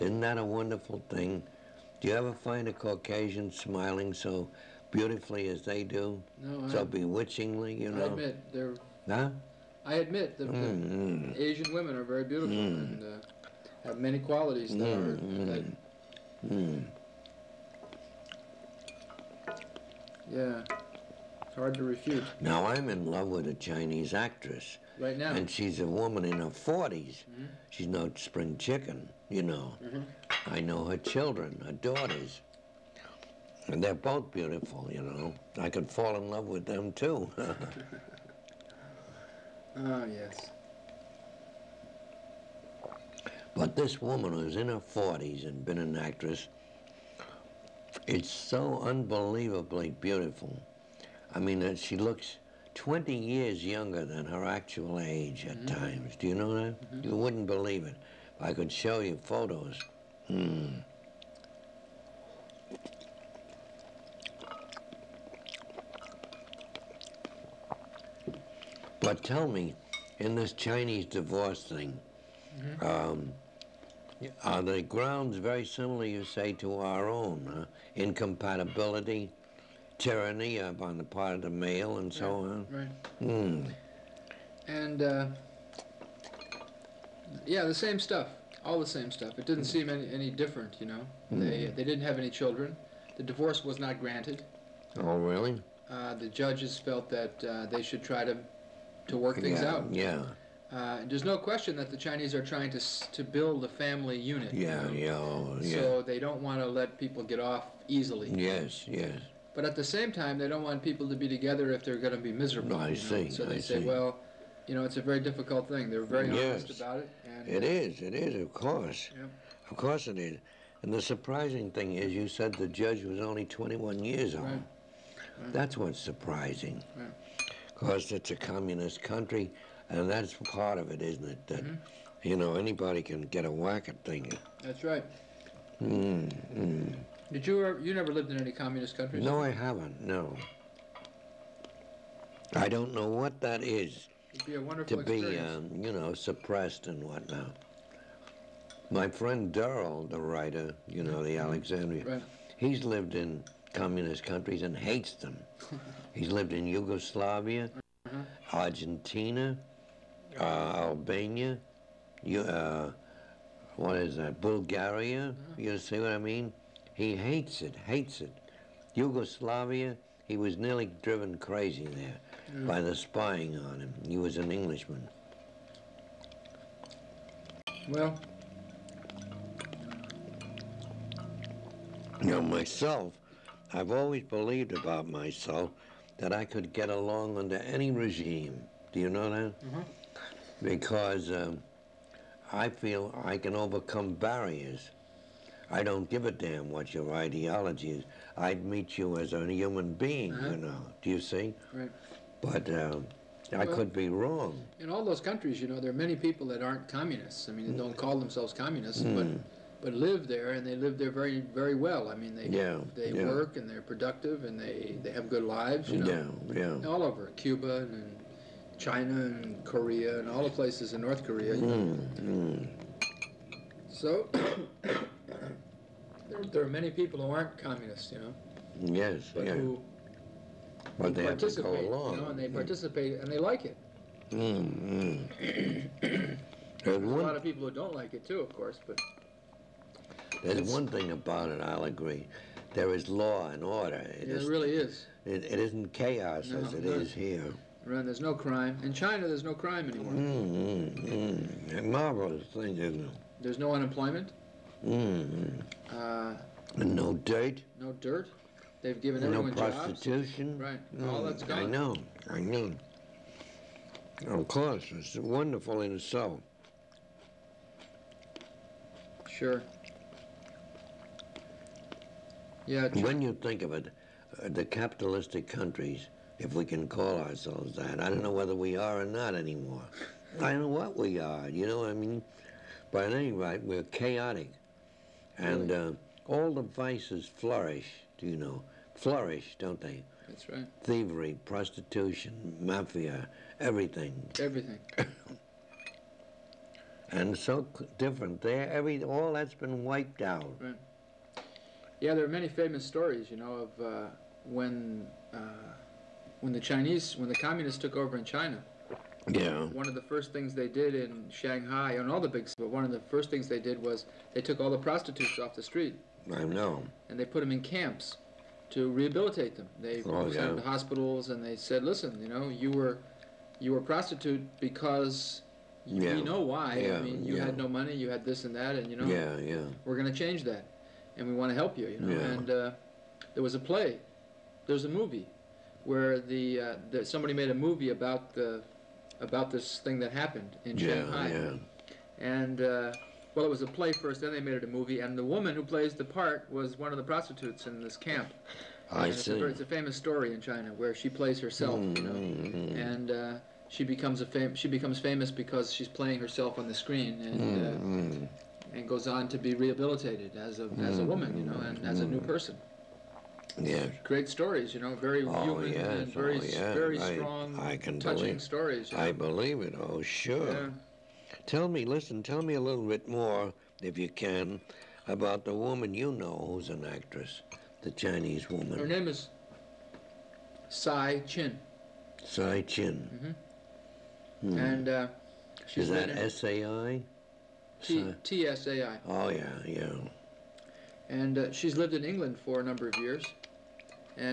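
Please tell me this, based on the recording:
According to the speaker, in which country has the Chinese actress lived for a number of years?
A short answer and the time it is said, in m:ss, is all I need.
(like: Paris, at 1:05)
England, at 6:32.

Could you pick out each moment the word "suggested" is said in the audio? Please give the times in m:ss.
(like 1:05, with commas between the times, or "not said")
not said.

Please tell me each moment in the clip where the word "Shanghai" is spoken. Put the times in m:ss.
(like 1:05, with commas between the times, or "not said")
5:11, 5:40.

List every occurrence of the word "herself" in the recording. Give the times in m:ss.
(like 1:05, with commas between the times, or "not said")
5:51, 5:56.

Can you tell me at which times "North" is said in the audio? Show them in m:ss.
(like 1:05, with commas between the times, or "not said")
3:41.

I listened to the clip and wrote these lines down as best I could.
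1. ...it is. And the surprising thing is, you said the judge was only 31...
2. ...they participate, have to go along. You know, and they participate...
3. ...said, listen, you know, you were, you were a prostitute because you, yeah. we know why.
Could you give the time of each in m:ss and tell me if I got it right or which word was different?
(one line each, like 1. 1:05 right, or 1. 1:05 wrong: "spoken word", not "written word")
1. 2:00 wrong: "21", not "31"
2. 3:51 right
3. 5:21 right.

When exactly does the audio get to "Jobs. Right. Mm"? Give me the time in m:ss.
4:20.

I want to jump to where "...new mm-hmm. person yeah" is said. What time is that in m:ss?
6:02.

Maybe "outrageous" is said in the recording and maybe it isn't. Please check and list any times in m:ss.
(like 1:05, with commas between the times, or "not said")
not said.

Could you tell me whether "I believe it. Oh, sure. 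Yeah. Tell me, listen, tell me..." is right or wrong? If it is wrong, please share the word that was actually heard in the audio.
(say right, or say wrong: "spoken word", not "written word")
right.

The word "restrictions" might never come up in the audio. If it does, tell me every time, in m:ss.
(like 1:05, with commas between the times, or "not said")
not said.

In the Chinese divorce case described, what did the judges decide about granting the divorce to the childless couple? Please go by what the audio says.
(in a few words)
Not granted.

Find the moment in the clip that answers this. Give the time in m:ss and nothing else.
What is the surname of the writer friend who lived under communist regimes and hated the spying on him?
2:29.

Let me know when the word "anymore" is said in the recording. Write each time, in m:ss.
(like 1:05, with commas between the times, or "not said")
4:09, 4:39.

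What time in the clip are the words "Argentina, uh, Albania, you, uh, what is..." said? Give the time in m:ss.
2:38.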